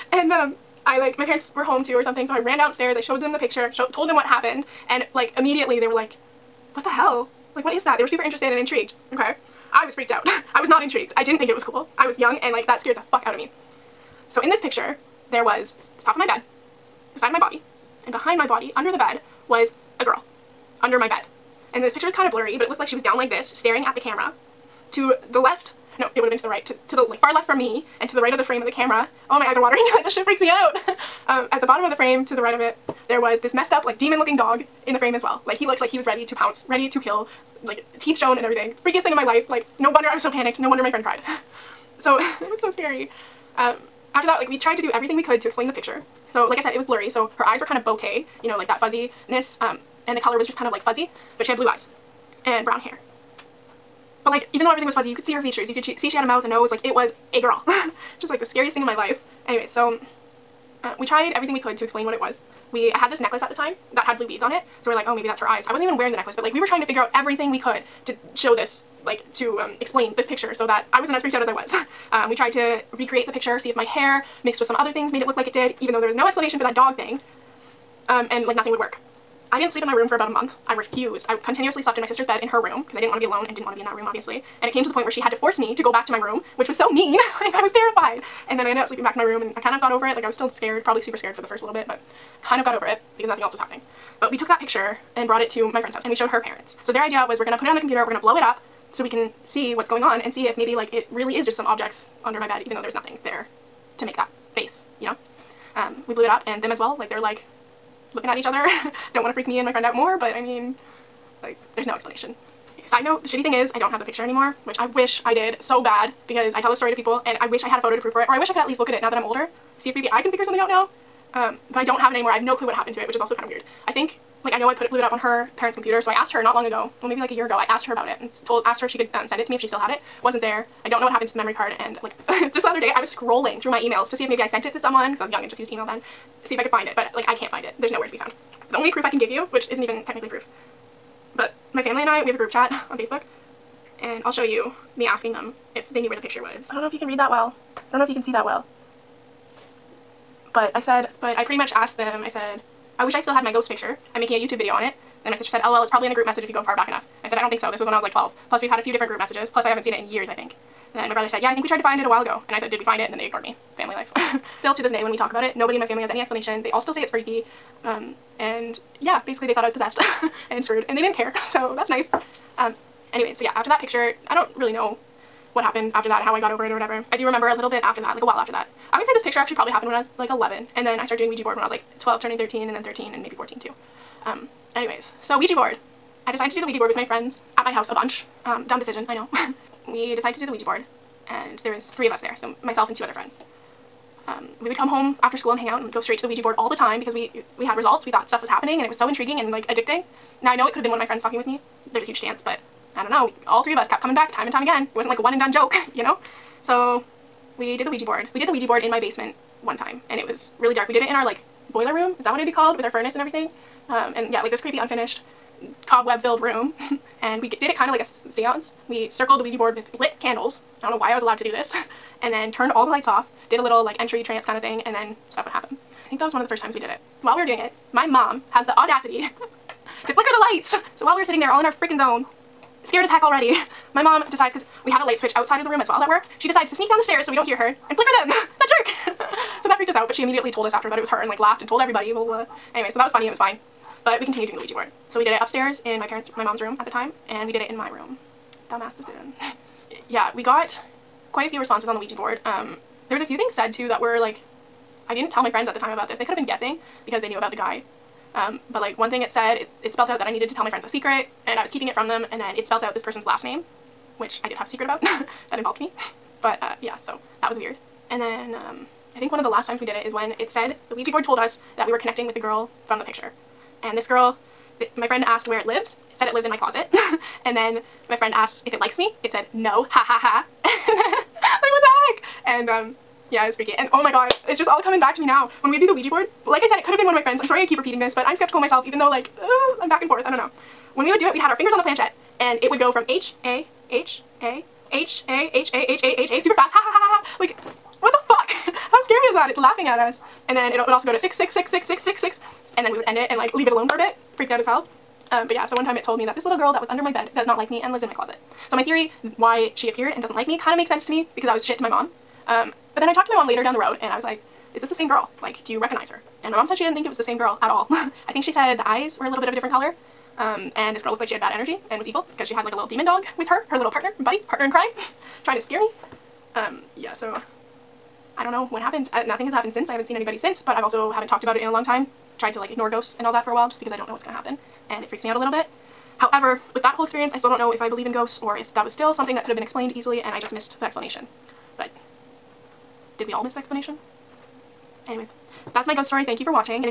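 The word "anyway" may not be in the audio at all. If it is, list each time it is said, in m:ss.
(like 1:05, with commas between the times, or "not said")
0:59, 2:53, 3:04, 4:02, 5:45.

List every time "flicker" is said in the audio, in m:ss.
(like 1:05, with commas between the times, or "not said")
3:50, 3:57.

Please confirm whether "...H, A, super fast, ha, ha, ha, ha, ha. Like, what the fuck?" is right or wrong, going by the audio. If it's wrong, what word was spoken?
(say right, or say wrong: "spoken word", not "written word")
right.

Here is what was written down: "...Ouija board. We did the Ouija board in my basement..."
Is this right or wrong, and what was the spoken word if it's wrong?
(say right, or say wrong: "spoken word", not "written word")
right.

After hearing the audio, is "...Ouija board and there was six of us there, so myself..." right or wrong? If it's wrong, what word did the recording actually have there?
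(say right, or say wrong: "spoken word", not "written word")
wrong: "three", not "six".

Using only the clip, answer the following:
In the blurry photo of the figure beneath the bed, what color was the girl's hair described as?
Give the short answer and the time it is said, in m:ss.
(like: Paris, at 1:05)
brown, at 0:52.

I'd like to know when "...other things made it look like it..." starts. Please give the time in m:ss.
1:14.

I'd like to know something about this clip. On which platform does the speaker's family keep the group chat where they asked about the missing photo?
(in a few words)
Facebook.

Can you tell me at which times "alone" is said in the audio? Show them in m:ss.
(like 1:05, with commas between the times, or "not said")
1:23, 5:03.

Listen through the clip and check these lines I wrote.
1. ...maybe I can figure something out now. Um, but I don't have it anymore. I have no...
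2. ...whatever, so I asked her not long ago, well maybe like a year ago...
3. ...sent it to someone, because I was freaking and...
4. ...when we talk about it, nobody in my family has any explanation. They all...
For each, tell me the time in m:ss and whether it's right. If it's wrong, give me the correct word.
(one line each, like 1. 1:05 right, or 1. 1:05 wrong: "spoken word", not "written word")
1. 1:59 right
2. 2:05 wrong: "computer", not "whatever"
3. 2:14 wrong: "young", not "freaking"
4. 2:45 right.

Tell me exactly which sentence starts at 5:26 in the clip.
Um, yeah, so I don't know what happened.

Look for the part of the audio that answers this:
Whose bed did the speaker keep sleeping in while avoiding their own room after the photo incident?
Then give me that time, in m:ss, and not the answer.
1:22.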